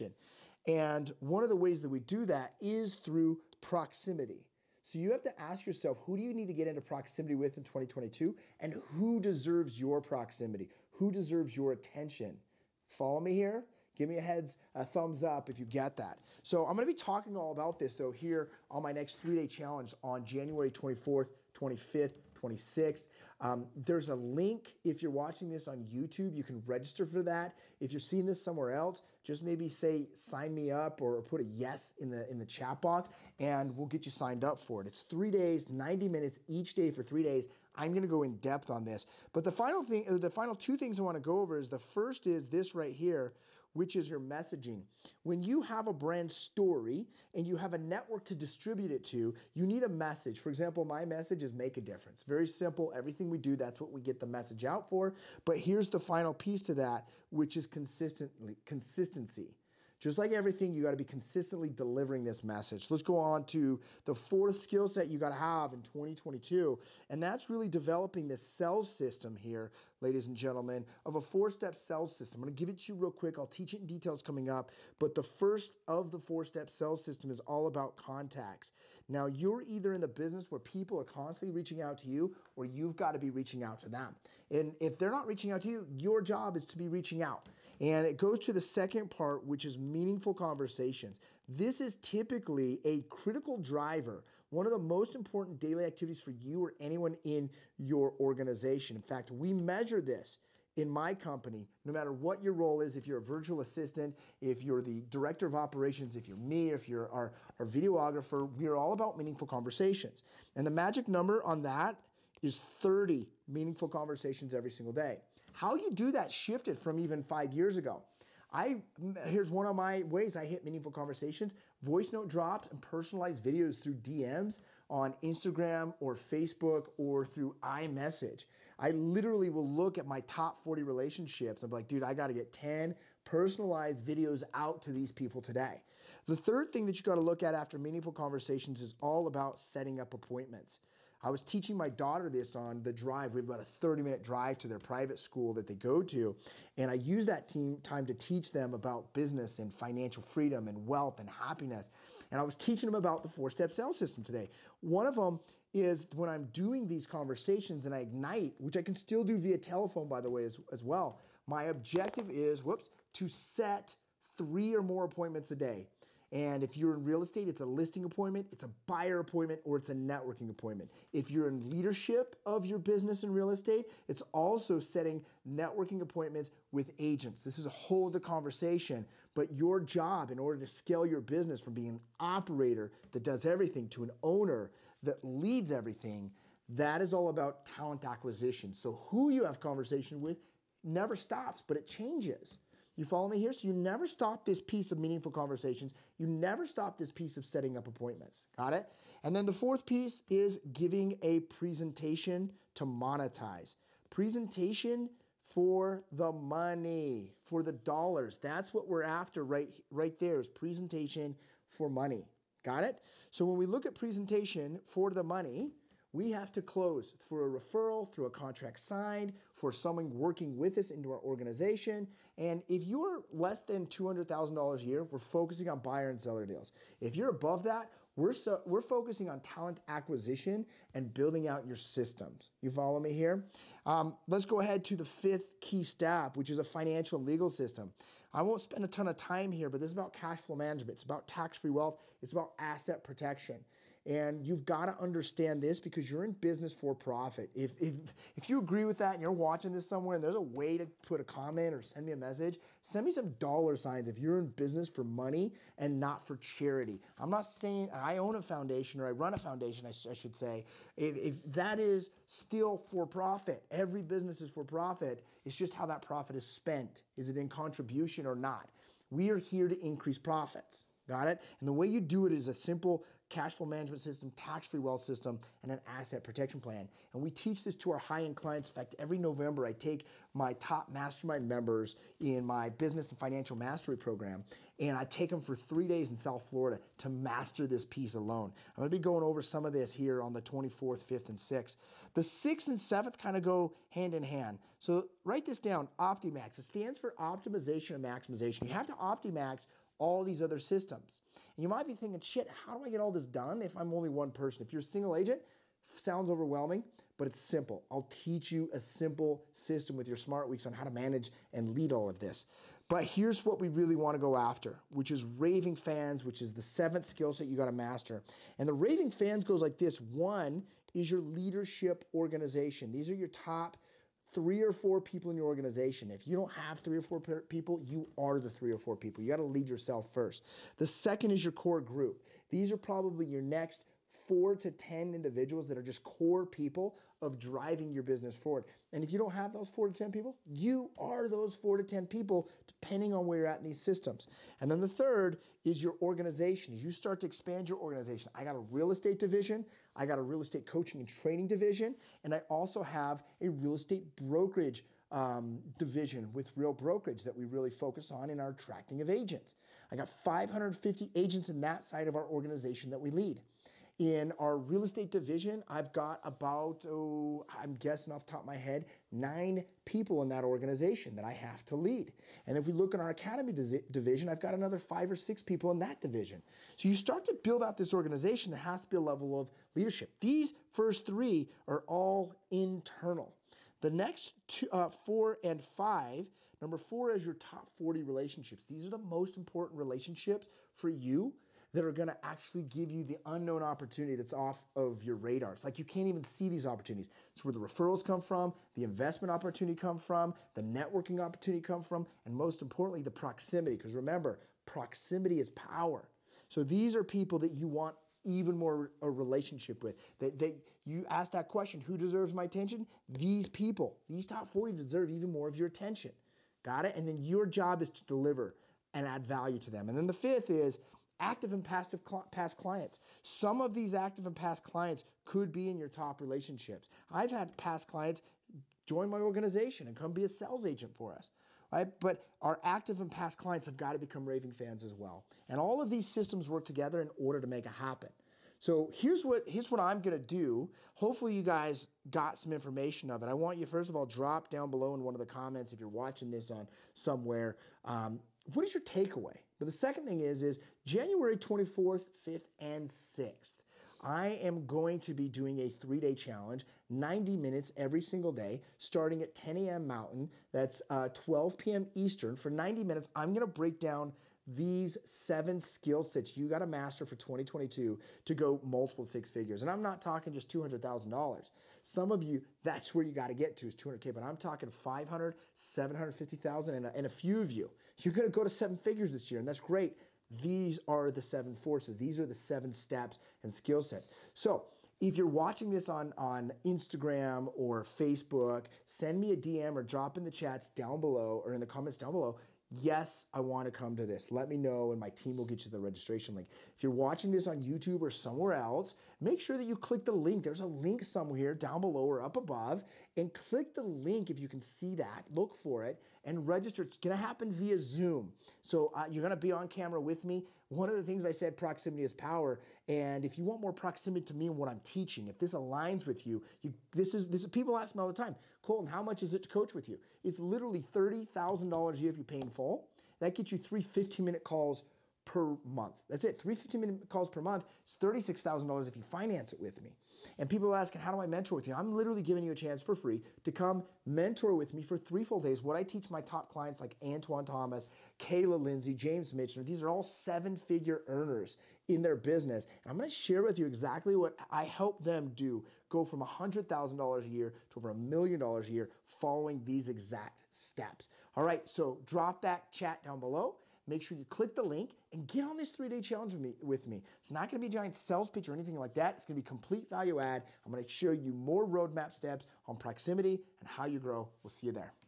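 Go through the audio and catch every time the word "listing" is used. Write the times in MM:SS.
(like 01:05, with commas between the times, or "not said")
02:47.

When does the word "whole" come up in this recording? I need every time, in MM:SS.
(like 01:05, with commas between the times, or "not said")
02:57.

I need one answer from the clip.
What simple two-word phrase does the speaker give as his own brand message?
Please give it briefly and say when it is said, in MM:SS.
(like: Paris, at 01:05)
Make a difference, at 00:51.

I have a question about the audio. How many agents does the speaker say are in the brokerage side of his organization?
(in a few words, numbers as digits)
550.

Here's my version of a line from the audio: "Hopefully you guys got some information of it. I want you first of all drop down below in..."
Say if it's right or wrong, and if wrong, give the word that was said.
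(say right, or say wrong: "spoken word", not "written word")
right.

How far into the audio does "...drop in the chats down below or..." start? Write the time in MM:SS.
08:09.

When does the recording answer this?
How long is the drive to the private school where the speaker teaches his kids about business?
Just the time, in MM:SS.
02:23.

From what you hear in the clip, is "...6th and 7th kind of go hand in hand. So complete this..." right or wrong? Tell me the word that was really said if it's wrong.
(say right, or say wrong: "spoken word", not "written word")
wrong: "write", not "complete".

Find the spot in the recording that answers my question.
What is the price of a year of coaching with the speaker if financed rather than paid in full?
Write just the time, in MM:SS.
08:47.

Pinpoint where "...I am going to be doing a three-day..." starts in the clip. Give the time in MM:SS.
07:34.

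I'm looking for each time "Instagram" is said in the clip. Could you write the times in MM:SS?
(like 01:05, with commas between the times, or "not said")
02:05, 08:06.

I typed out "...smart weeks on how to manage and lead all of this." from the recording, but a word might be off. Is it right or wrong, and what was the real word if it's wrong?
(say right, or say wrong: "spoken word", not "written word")
right.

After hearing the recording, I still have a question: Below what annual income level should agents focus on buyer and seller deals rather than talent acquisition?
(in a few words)
$200,000.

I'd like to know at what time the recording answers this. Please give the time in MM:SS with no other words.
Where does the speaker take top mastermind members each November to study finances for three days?
04:46.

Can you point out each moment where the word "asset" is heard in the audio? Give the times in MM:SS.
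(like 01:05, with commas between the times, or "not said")
04:02, 04:35.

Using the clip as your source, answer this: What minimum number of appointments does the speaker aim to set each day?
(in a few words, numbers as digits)
3.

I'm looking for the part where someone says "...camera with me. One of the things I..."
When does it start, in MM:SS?
08:29.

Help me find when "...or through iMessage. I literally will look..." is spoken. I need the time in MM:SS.
02:06.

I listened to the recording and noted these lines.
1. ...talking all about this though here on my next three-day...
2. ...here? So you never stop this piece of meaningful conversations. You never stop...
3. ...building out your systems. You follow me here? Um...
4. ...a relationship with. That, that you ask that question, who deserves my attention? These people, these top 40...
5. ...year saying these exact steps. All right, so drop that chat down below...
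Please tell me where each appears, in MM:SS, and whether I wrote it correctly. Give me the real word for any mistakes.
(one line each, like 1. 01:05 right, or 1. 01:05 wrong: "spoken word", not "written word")
1. 00:16 right
2. 03:13 right
3. 03:51 right
4. 06:49 right
5. 09:08 wrong: "following", not "saying".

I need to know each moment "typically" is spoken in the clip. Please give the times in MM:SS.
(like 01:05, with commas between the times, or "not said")
01:32.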